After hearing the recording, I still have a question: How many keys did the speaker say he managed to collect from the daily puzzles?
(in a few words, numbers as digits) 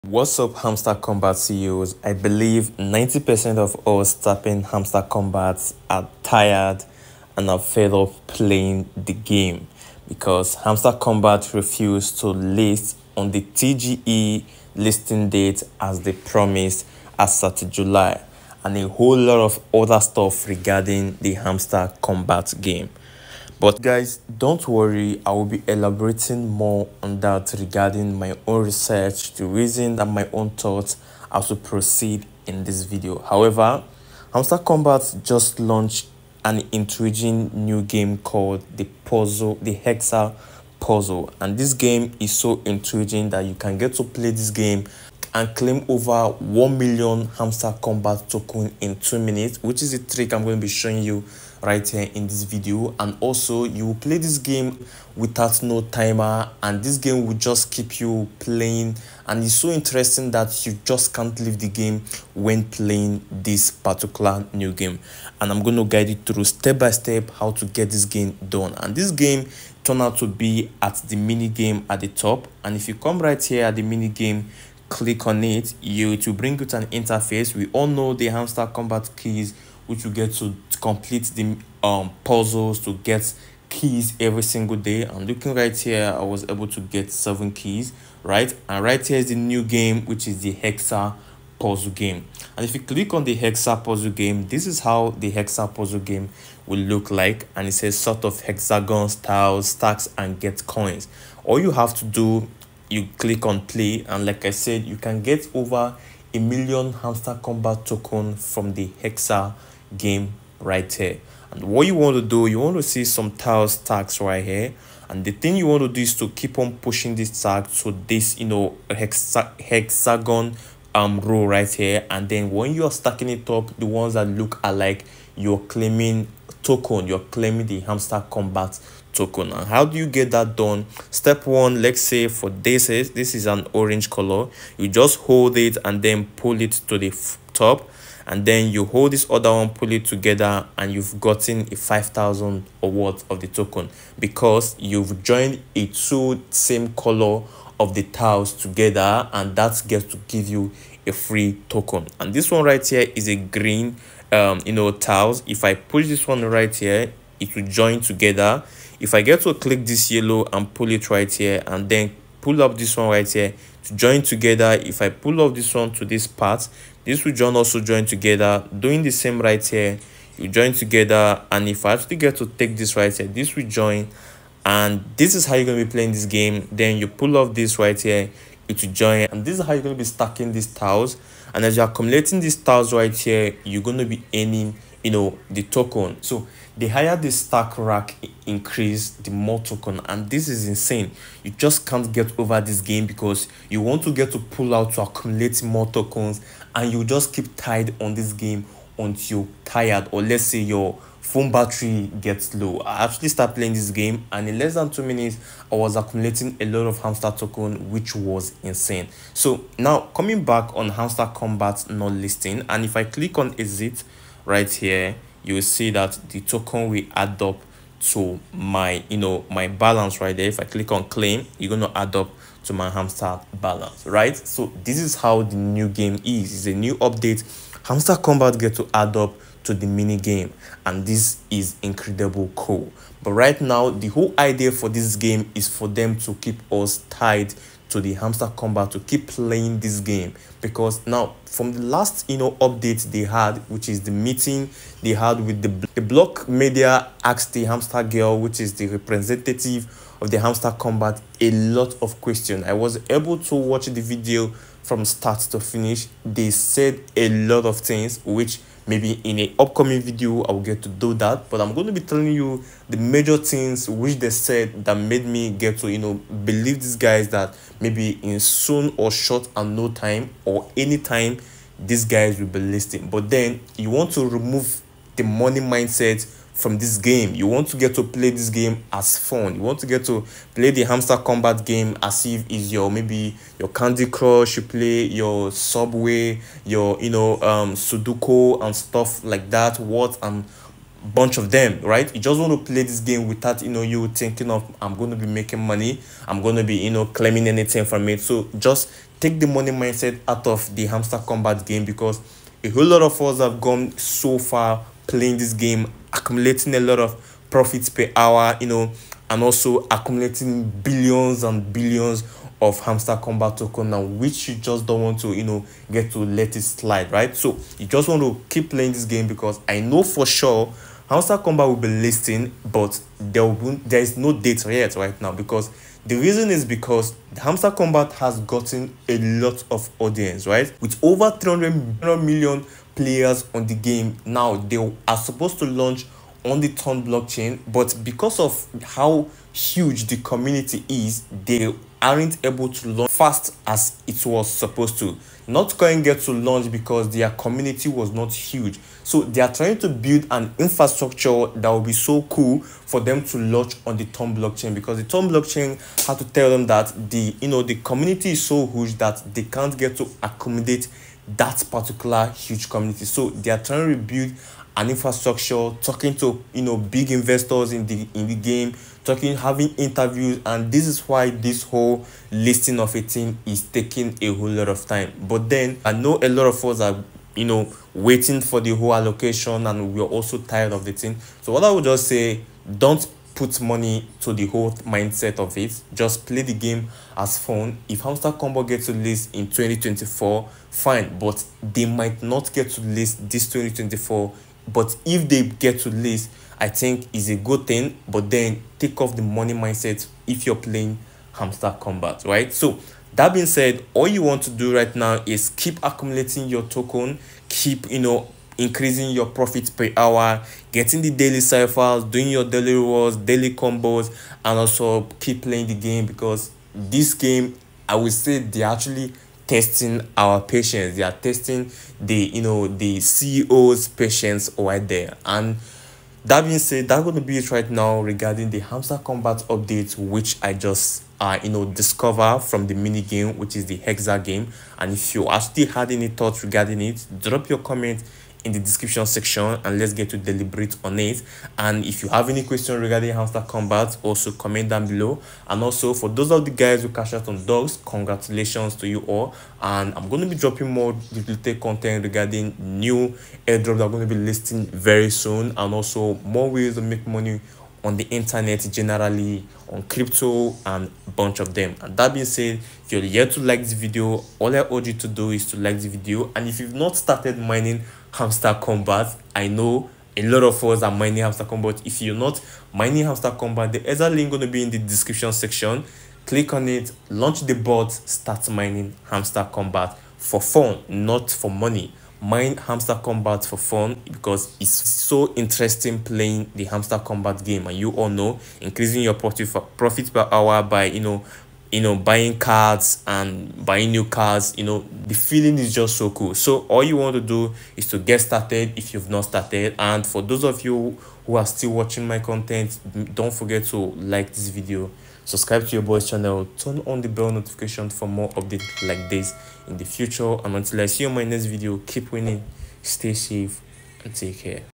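7.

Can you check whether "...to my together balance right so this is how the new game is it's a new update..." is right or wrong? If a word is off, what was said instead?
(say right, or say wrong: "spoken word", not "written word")
wrong: "hamster", not "together".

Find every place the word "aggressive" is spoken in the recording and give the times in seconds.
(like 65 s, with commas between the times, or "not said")
not said.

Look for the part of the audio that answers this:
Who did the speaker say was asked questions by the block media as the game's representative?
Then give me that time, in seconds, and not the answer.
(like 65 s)
247 s.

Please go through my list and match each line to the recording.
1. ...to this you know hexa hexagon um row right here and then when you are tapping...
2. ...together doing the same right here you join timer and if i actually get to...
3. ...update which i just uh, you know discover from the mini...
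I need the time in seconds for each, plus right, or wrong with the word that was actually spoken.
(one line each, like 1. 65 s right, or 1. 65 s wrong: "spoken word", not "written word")
1. 117 s wrong: "stacking", not "tapping"
2. 168 s wrong: "together", not "timer"
3. 429 s right.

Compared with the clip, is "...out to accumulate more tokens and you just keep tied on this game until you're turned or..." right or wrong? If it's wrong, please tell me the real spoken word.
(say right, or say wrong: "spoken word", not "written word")
wrong: "tired", not "turned".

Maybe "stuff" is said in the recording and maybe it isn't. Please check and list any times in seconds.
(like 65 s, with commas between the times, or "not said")
20 s, 288 s.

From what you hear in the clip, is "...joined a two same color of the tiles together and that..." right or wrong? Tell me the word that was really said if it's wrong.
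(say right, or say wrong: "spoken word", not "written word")
right.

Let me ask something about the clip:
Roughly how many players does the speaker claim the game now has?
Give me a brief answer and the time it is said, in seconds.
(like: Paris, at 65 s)
300 million, at 331 s.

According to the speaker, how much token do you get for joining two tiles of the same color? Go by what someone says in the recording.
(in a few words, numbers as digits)
5000.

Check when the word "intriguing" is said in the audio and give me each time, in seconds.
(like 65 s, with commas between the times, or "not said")
36 s, 42 s.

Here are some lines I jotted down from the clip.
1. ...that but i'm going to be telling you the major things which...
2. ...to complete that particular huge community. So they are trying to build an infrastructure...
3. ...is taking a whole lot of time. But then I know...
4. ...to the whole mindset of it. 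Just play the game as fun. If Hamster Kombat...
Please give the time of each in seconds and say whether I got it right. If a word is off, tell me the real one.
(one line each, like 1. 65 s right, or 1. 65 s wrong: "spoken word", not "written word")
1. 261 s right
2. 359 s wrong: "accommodate", not "complete"
3. 373 s right
4. 384 s right.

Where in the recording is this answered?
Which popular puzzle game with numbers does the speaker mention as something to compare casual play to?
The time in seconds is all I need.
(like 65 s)
287 s.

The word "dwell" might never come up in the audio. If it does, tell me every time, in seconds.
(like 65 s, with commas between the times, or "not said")
not said.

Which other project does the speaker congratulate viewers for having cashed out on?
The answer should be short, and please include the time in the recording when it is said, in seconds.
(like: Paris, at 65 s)
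Dogs, at 447 s.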